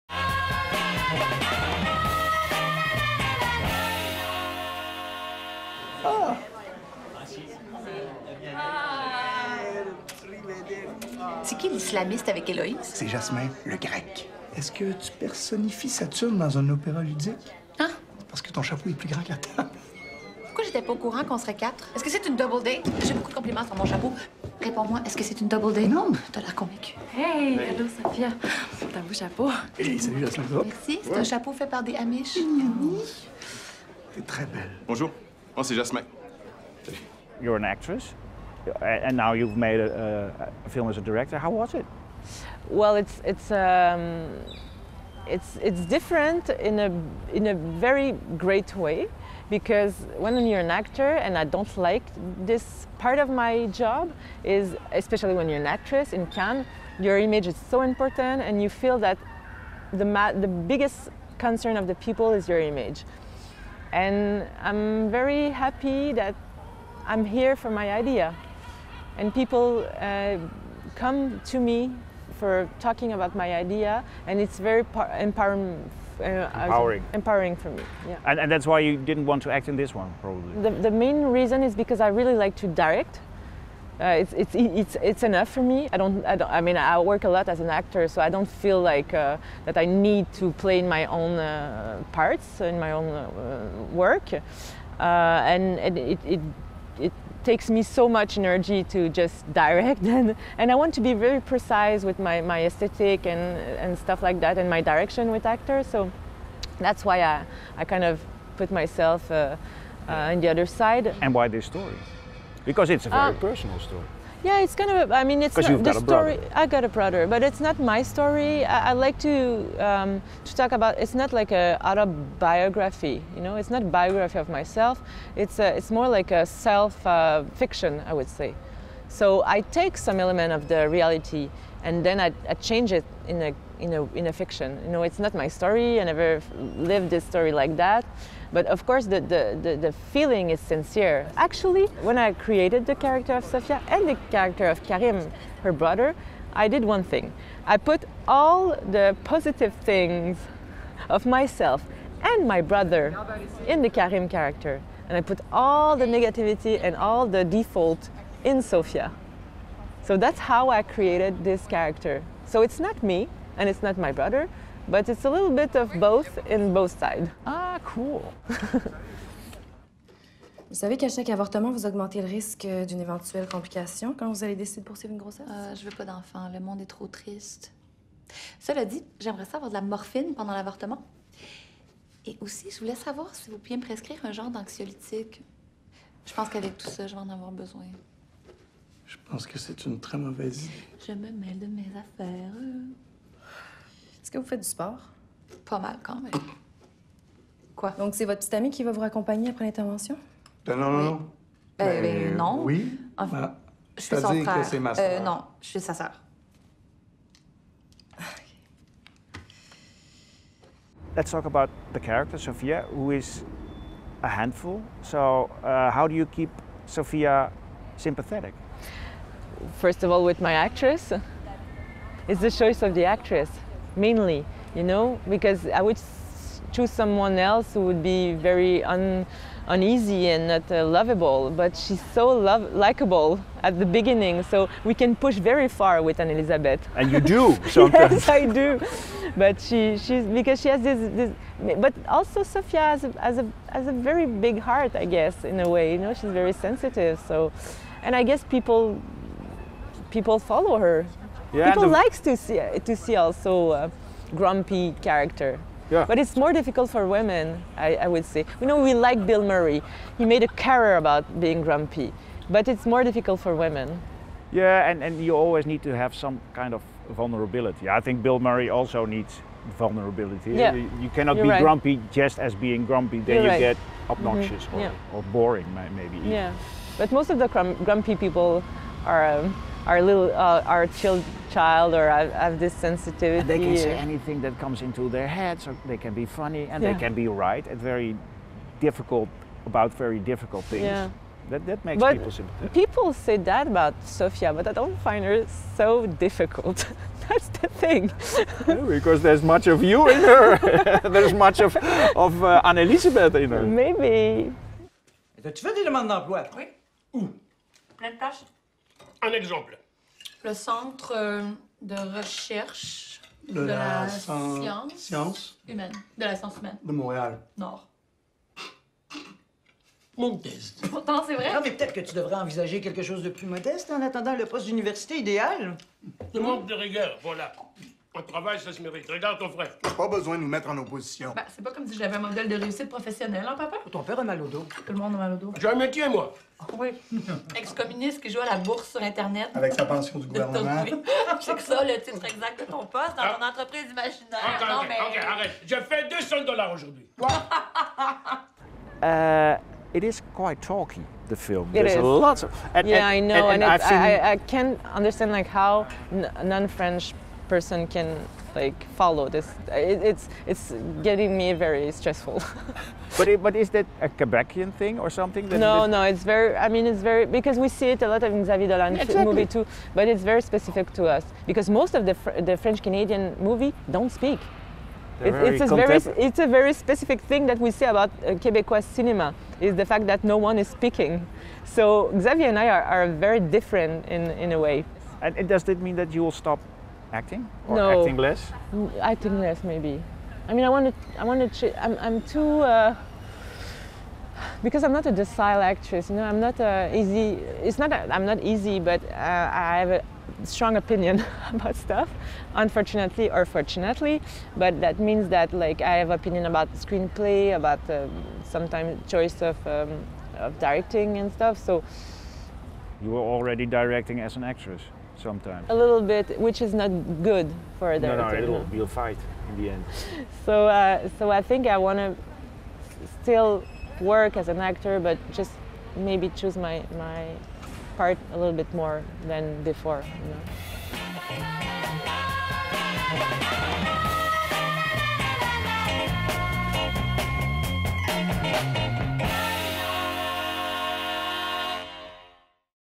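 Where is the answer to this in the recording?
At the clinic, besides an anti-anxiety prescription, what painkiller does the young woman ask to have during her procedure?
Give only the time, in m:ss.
2:59.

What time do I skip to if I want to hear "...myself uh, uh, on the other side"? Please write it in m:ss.
1:48.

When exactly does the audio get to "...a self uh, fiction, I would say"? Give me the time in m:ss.
2:06.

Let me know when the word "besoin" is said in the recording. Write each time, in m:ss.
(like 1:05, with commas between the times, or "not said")
3:07, 5:30.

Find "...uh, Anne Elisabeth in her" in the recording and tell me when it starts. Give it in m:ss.
5:02.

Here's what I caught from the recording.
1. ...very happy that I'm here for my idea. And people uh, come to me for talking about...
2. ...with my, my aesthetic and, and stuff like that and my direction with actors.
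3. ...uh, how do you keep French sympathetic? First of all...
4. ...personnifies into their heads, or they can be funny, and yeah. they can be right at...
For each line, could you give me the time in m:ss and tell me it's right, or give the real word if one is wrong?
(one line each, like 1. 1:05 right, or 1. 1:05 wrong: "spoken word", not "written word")
1. 1:05 right
2. 1:42 right
3. 3:35 wrong: "Sophia", not "French"
4. 4:44 wrong: "comes", not "personnifies".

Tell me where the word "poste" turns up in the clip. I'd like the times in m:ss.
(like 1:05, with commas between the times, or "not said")
5:24, 5:42.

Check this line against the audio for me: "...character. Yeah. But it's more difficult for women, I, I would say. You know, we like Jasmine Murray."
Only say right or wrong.
wrong.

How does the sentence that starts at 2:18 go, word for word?
But of course, the, the, the, the feeling is sincere.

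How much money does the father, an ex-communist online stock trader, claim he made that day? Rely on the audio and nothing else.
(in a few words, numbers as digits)
200 dollars.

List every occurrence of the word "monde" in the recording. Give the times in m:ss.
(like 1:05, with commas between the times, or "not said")
2:56, 5:34.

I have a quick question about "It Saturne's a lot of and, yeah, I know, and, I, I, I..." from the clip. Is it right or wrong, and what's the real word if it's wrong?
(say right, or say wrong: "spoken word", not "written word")
wrong: "There", not "Saturne".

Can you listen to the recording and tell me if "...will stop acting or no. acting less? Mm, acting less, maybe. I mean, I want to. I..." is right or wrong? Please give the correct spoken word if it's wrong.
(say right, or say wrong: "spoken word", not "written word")
right.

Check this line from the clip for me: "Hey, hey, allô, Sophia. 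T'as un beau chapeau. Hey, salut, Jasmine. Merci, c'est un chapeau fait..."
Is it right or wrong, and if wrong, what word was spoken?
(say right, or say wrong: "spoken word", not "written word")
right.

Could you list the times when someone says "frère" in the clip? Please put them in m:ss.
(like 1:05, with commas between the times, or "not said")
3:24, 5:29.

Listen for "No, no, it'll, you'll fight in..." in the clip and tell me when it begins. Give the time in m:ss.
6:58.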